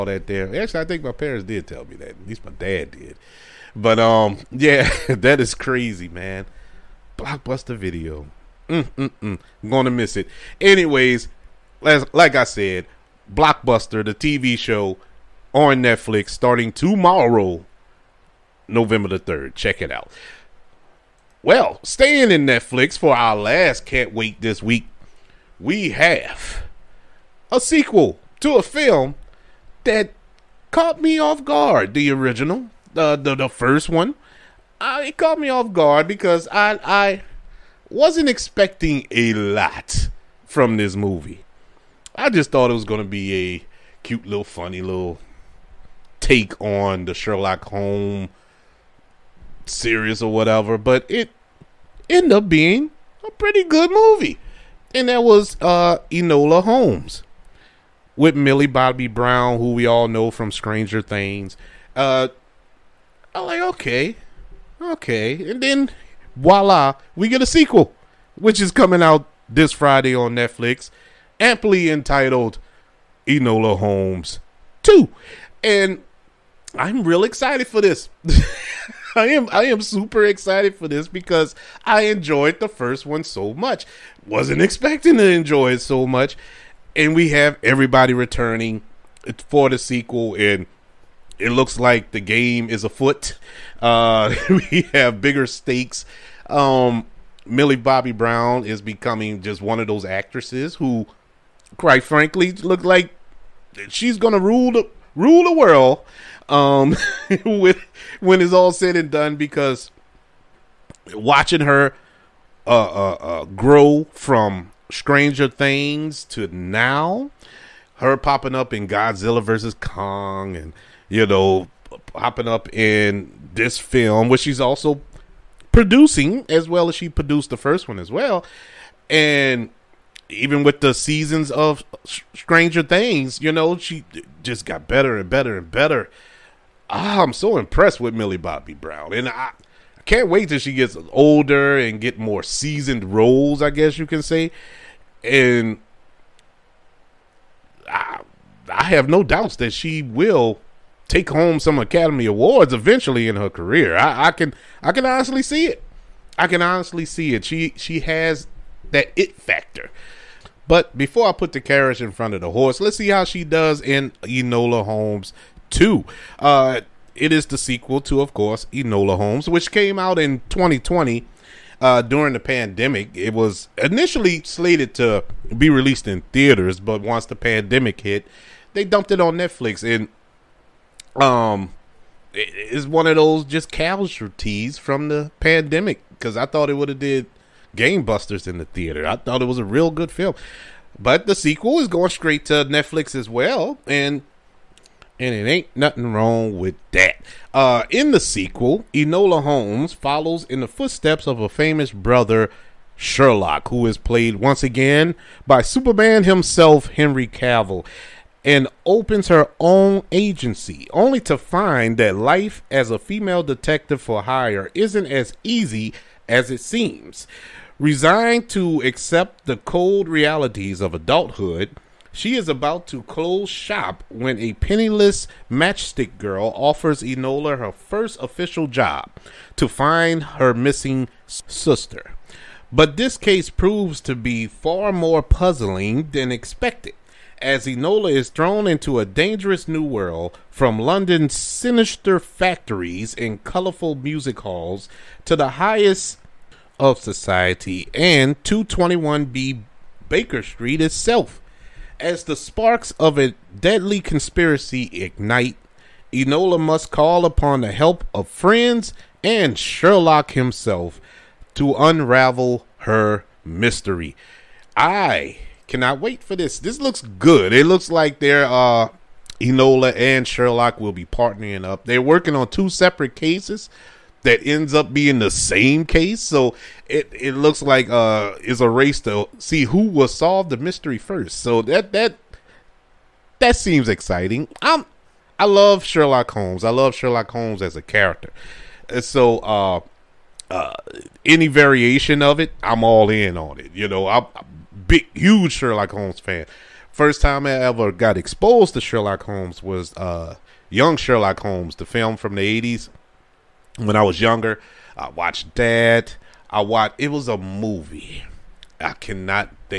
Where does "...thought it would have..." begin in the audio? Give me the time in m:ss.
3:06.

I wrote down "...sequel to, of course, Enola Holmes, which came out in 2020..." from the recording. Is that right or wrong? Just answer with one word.
right.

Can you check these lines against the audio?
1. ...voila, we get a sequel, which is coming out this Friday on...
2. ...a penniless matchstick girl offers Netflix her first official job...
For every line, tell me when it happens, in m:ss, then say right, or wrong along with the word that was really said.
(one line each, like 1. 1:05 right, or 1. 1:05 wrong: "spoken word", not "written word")
1. 1:06 right
2. 3:44 wrong: "Enola", not "Netflix".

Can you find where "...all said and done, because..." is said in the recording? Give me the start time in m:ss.
1:48.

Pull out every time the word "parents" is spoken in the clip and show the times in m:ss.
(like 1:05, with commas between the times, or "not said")
0:01.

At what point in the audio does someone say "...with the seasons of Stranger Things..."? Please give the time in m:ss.
2:10.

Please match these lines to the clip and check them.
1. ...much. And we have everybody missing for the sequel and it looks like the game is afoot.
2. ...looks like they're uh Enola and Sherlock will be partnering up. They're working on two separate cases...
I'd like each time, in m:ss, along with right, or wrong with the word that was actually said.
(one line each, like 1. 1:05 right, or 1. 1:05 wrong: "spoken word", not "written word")
1. 1:26 wrong: "returning", not "missing"
2. 4:27 right.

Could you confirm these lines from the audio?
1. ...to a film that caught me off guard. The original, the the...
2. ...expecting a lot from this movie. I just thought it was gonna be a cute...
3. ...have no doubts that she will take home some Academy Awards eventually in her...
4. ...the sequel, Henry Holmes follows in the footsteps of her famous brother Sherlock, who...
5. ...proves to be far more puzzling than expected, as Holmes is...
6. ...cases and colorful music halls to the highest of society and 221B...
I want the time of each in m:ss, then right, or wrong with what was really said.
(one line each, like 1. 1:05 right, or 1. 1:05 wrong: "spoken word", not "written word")
1. 0:28 right
2. 0:38 right
3. 2:28 right
4. 3:18 wrong: "Enola", not "Henry"
5. 3:53 wrong: "Enola", not "Holmes"
6. 4:02 wrong: "factories", not "cases".